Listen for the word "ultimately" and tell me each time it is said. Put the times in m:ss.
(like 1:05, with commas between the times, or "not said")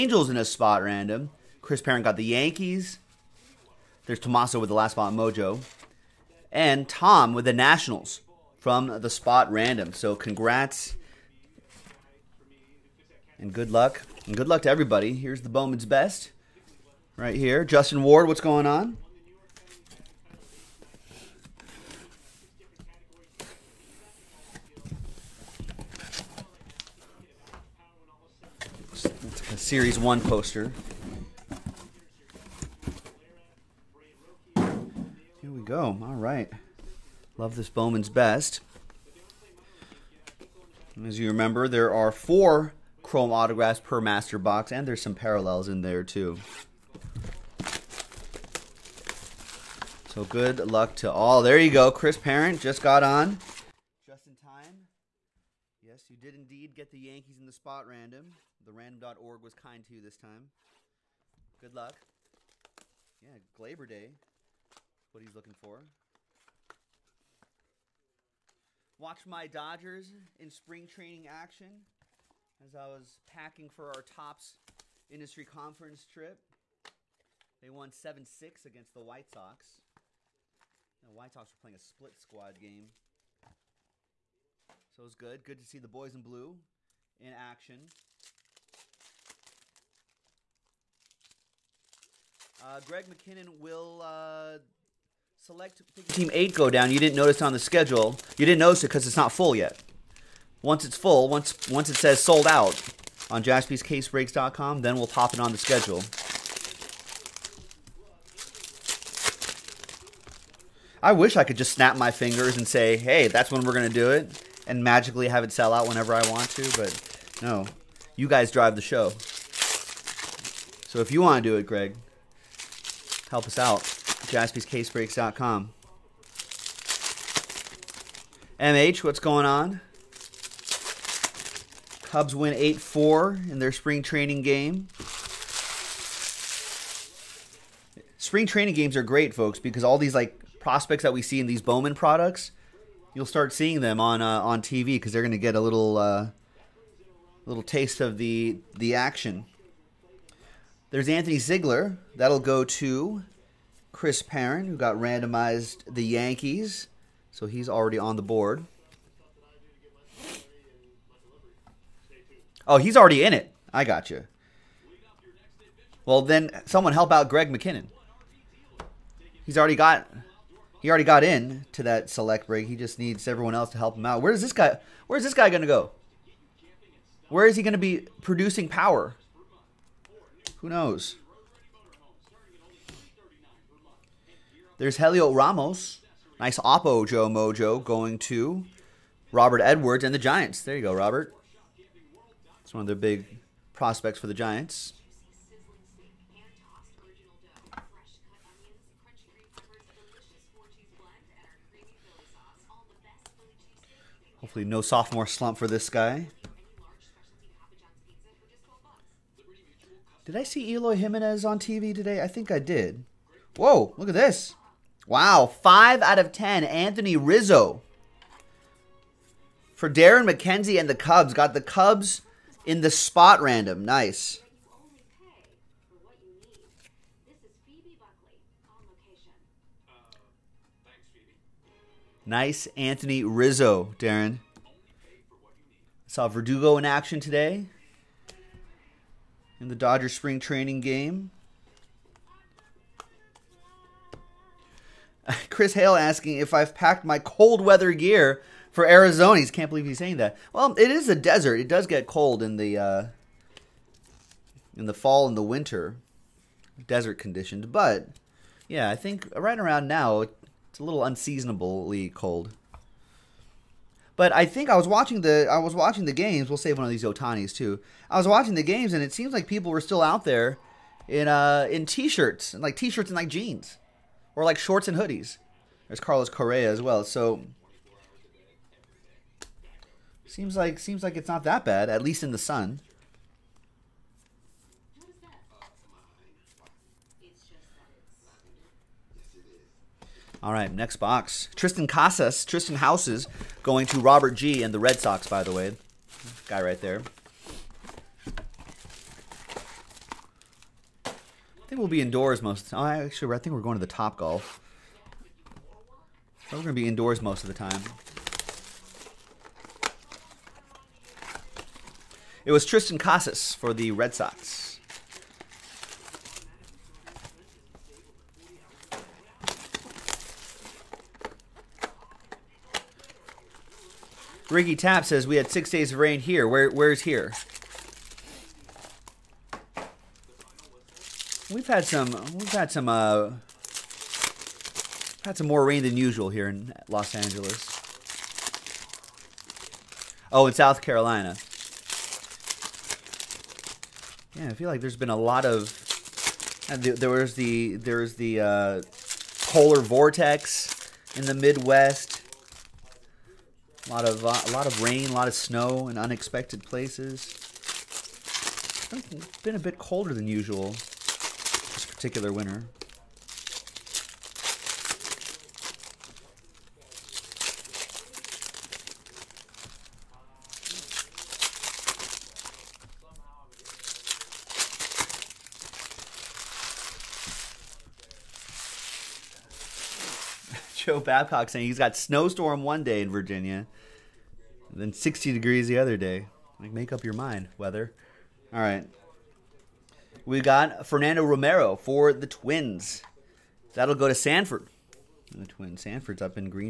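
not said.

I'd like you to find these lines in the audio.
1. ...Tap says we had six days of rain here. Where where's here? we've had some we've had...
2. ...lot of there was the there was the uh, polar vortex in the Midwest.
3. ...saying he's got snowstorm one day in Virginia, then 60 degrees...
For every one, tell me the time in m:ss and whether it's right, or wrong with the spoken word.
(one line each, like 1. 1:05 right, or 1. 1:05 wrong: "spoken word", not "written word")
1. 5:24 right
2. 5:45 right
3. 6:21 right.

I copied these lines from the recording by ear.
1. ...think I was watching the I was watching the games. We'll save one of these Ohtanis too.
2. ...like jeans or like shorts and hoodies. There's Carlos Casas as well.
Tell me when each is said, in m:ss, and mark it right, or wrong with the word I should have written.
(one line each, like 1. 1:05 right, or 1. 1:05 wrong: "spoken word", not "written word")
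1. 4:24 right
2. 4:33 wrong: "Correa", not "Casas".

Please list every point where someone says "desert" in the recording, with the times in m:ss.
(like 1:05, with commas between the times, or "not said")
4:11, 4:16.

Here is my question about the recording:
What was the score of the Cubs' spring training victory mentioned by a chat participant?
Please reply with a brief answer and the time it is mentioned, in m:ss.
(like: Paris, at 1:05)
8-4, at 2:12.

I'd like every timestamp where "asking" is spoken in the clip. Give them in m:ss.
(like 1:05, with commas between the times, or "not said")
4:05.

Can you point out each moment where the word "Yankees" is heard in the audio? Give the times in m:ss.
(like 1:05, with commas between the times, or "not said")
0:02, 0:57, 2:36.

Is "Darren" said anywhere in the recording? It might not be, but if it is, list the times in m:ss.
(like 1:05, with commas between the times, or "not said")
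3:39, 3:53.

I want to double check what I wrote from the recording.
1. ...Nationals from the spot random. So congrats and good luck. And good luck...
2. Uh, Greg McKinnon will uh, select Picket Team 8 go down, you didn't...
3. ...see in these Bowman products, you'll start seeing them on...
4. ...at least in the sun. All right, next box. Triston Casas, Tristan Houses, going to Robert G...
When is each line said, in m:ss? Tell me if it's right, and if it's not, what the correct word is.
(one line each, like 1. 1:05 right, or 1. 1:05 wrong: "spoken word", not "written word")
1. 0:07 right
2. 1:32 right
3. 2:21 right
4. 4:41 right.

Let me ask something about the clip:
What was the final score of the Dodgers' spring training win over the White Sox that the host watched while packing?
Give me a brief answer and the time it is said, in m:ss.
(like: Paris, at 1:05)
7-6, at 1:17.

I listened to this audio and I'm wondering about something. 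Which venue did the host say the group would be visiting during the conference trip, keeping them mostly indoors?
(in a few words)
Top Golf.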